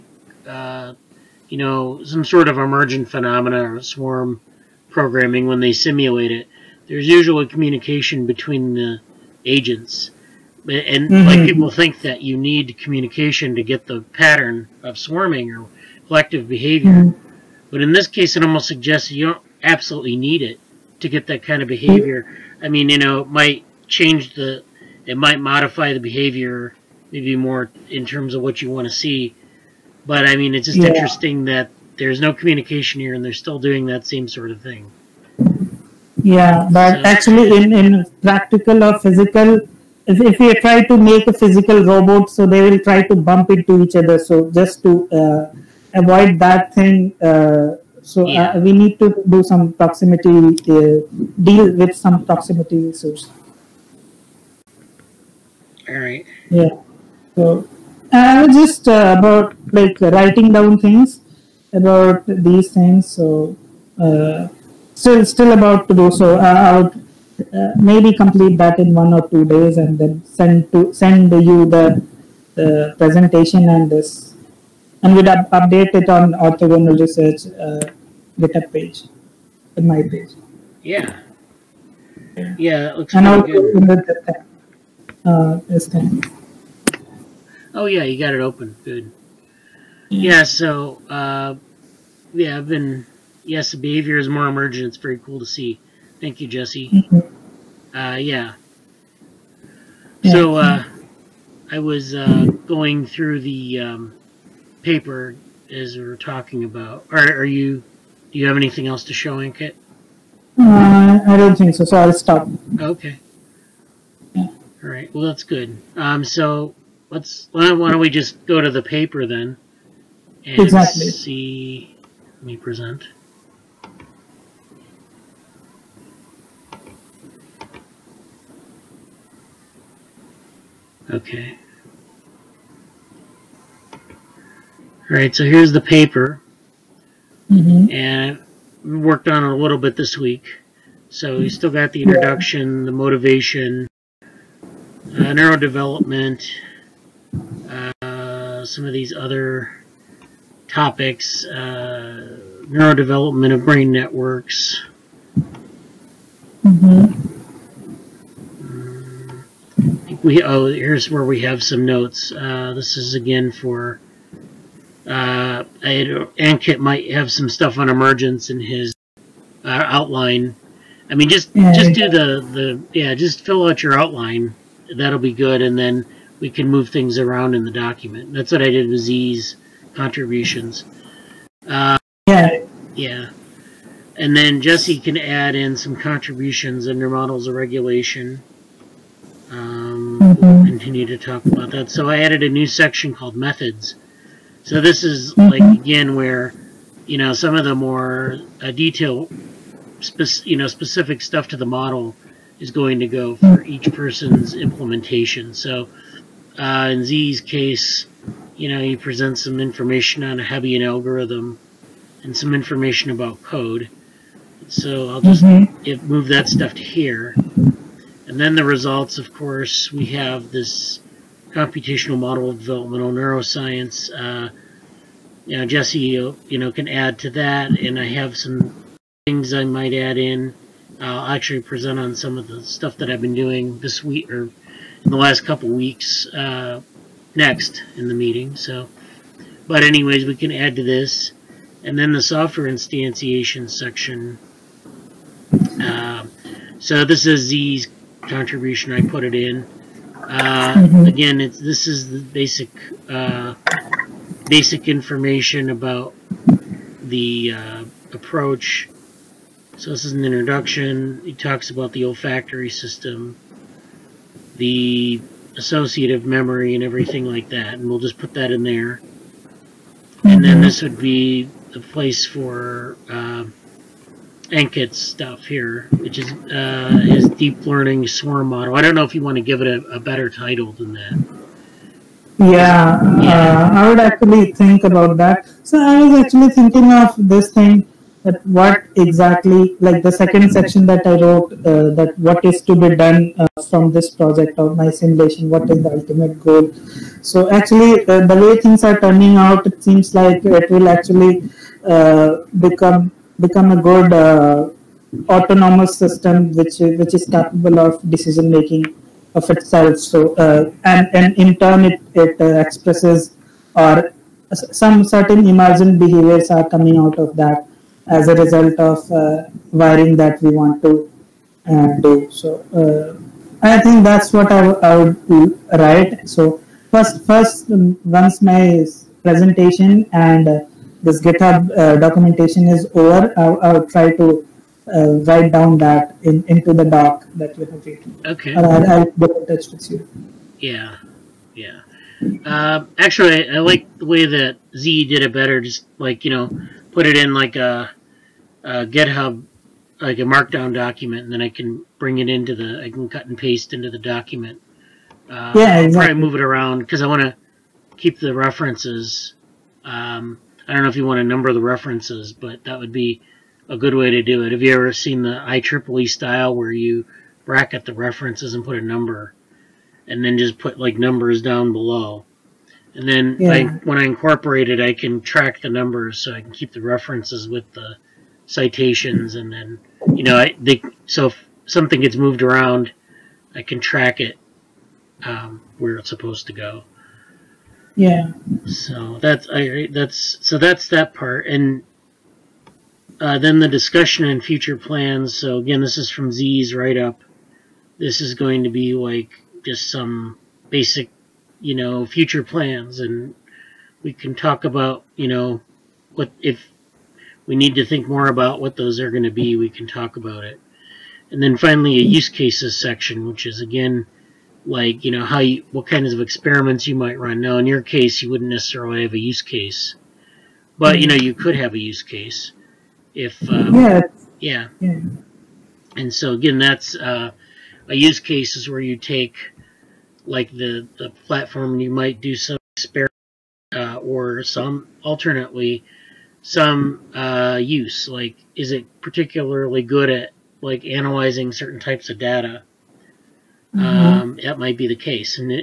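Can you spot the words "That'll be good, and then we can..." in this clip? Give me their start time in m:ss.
2:54.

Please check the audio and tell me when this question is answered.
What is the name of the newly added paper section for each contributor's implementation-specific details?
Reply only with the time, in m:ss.
3:13.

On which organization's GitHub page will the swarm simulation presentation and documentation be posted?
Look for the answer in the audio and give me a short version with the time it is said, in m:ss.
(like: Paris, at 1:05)
Orthogonal Research, at 1:16.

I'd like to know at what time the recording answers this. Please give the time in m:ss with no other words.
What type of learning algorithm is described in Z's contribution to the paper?
3:30.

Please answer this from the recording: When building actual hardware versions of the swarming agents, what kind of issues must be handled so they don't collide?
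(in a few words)
proximity issues.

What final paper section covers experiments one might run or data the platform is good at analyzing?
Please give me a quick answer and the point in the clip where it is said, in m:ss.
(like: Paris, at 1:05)
use cases, at 6:52.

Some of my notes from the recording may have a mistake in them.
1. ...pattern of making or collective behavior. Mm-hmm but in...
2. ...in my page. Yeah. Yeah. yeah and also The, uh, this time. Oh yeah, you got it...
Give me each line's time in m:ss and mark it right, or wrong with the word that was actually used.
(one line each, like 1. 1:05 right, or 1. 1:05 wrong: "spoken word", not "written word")
1. 0:14 wrong: "swarming", not "making"
2. 1:19 right.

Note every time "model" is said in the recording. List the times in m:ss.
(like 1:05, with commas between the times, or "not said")
3:07, 3:21, 3:42, 4:38.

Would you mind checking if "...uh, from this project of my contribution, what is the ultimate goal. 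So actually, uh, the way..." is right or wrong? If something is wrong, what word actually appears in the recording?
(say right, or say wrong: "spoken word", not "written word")
wrong: "simulation", not "contribution".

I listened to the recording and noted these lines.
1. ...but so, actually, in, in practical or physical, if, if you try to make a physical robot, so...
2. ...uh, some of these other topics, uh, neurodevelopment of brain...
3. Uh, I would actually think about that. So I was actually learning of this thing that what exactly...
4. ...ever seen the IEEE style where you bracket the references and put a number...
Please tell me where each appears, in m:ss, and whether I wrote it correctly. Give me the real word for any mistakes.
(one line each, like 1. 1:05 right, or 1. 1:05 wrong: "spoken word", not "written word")
1. 0:36 right
2. 2:27 right
3. 4:43 wrong: "thinking", not "learning"
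4. 6:04 right.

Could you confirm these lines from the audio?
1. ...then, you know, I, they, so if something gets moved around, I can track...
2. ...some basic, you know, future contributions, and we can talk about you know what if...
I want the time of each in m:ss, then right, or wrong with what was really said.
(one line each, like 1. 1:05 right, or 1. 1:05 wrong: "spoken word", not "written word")
1. 6:19 right
2. 6:39 wrong: "plans", not "contributions".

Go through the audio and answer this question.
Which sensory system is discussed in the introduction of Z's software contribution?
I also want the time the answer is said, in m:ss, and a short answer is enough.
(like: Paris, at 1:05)
olfactory system, at 4:22.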